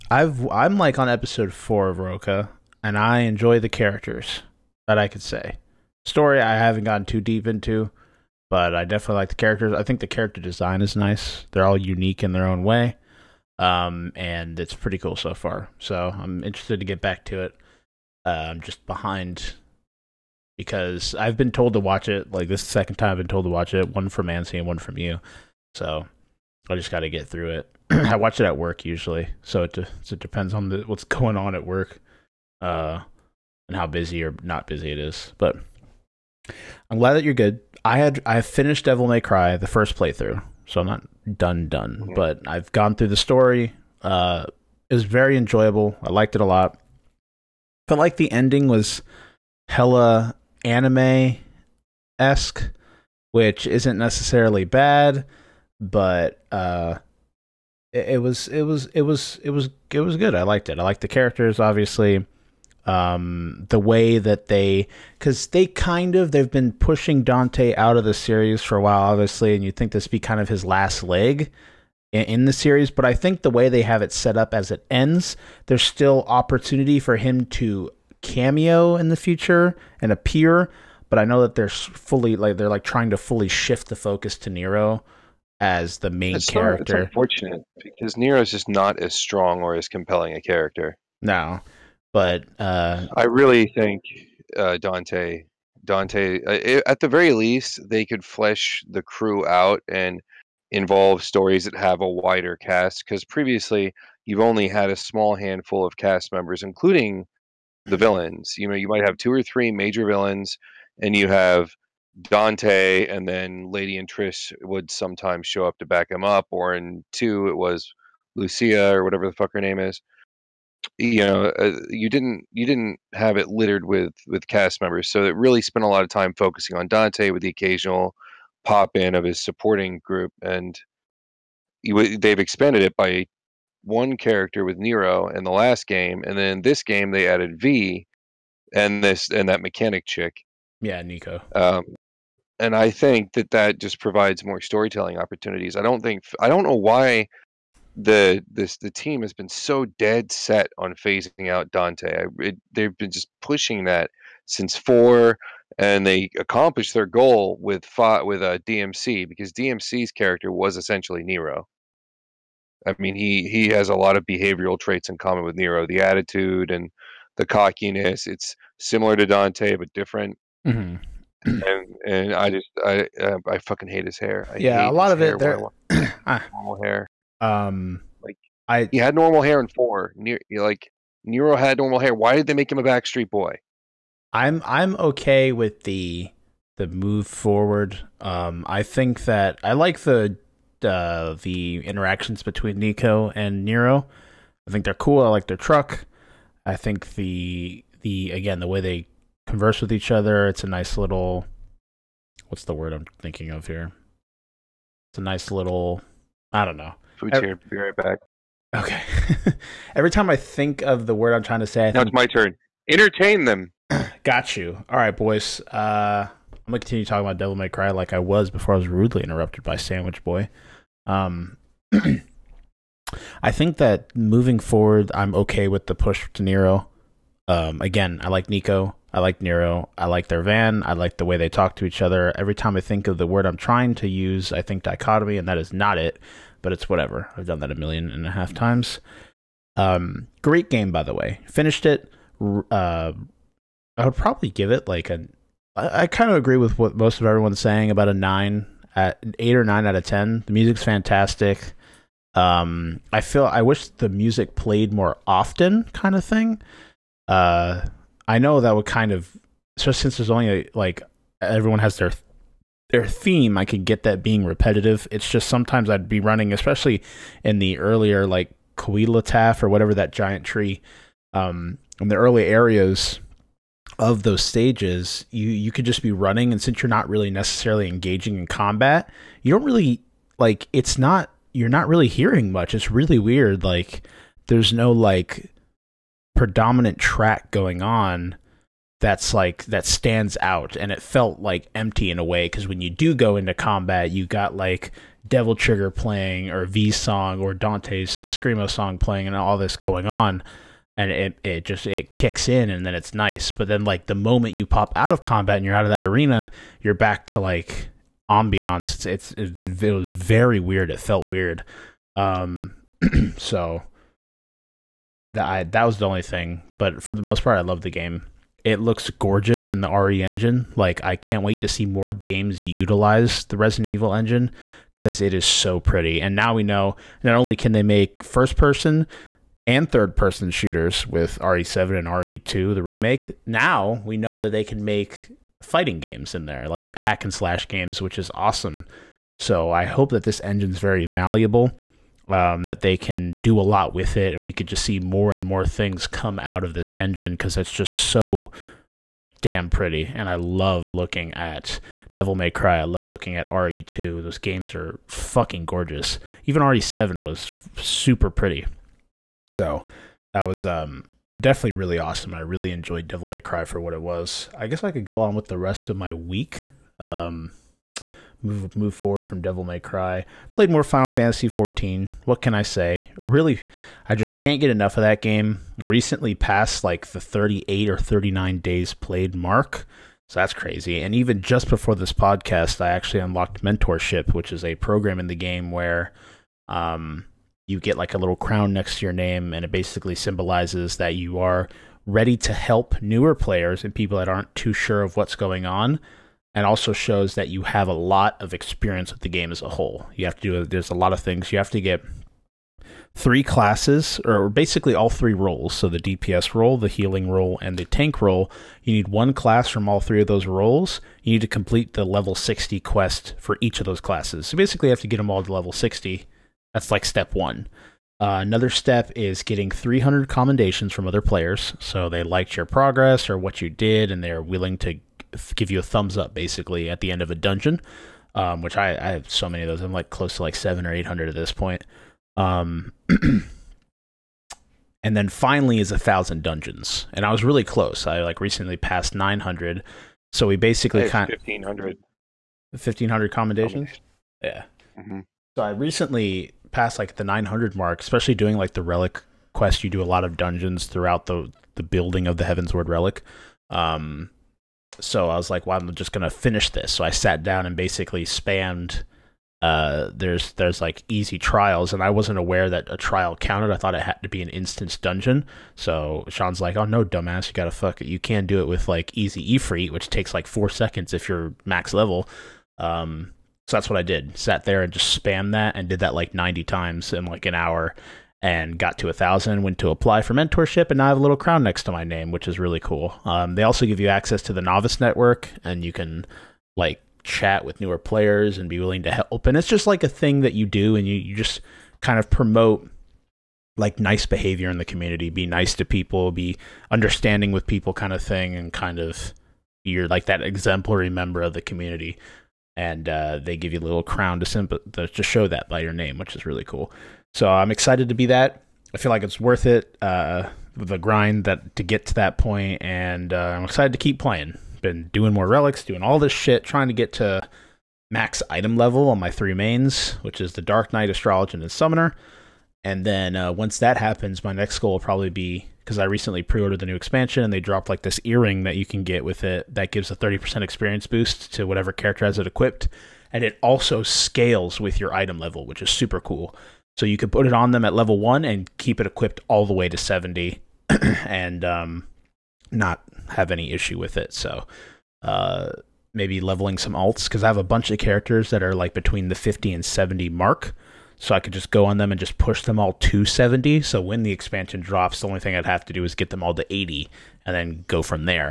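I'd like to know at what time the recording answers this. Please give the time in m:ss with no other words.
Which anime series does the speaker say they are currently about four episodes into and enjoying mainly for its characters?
0:01.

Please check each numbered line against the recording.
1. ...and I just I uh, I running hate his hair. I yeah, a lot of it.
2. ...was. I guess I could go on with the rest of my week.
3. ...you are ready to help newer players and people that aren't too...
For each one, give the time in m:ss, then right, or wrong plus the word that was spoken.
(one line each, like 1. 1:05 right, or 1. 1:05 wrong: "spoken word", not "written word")
1. 2:52 wrong: "fucking", not "running"
2. 6:04 right
3. 6:31 right.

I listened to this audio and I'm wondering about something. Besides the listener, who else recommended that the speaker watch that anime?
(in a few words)
Ansi.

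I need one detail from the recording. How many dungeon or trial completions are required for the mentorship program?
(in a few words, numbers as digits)
1000.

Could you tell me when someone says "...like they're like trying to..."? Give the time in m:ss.
1:22.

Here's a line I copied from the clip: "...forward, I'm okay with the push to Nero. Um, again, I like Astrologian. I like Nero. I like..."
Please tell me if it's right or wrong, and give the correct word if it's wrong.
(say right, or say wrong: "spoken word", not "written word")
wrong: "Nico", not "Astrologian".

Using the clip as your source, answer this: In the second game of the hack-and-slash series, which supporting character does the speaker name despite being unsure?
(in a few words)
Lucia.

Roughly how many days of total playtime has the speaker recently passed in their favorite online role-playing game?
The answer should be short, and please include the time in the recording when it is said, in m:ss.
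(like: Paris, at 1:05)
38 or 39 days, at 6:17.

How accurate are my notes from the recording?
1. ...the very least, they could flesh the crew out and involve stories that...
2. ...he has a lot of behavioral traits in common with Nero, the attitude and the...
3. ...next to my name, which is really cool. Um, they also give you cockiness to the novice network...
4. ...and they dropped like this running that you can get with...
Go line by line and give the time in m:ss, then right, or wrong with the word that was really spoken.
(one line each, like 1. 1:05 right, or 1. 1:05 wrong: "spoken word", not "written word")
1. 1:37 right
2. 2:43 right
3. 8:01 wrong: "access", not "cockiness"
4. 8:47 wrong: "earring", not "running".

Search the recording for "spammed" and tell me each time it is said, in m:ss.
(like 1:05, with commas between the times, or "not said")
7:38, 7:55.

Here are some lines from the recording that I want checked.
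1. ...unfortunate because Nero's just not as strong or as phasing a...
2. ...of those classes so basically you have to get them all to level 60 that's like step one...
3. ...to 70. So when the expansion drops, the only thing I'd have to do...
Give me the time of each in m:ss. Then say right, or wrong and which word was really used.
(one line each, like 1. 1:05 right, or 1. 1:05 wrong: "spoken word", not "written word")
1. 1:27 wrong: "compelling", not "phasing"
2. 6:53 right
3. 9:12 right.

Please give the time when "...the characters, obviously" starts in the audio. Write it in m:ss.
1:01.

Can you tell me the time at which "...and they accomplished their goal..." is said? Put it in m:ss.
2:35.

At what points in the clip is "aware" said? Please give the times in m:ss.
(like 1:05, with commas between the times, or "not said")
7:42.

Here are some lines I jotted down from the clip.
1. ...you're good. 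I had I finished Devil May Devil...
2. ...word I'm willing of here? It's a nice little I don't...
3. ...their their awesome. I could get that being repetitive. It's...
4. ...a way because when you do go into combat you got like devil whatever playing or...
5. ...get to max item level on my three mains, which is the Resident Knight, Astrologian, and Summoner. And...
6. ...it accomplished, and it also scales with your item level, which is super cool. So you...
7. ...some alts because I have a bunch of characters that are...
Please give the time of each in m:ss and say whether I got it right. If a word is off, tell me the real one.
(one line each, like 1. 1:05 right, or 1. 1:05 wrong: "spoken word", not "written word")
1. 0:37 wrong: "Cry", not "Devil"
2. 3:22 wrong: "thinking", not "willing"
3. 4:21 wrong: "theme", not "awesome"
4. 4:52 wrong: "trigger", not "whatever"
5. 8:36 wrong: "Dark", not "Resident"
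6. 8:52 wrong: "equipped", not "accomplished"
7. 9:06 right.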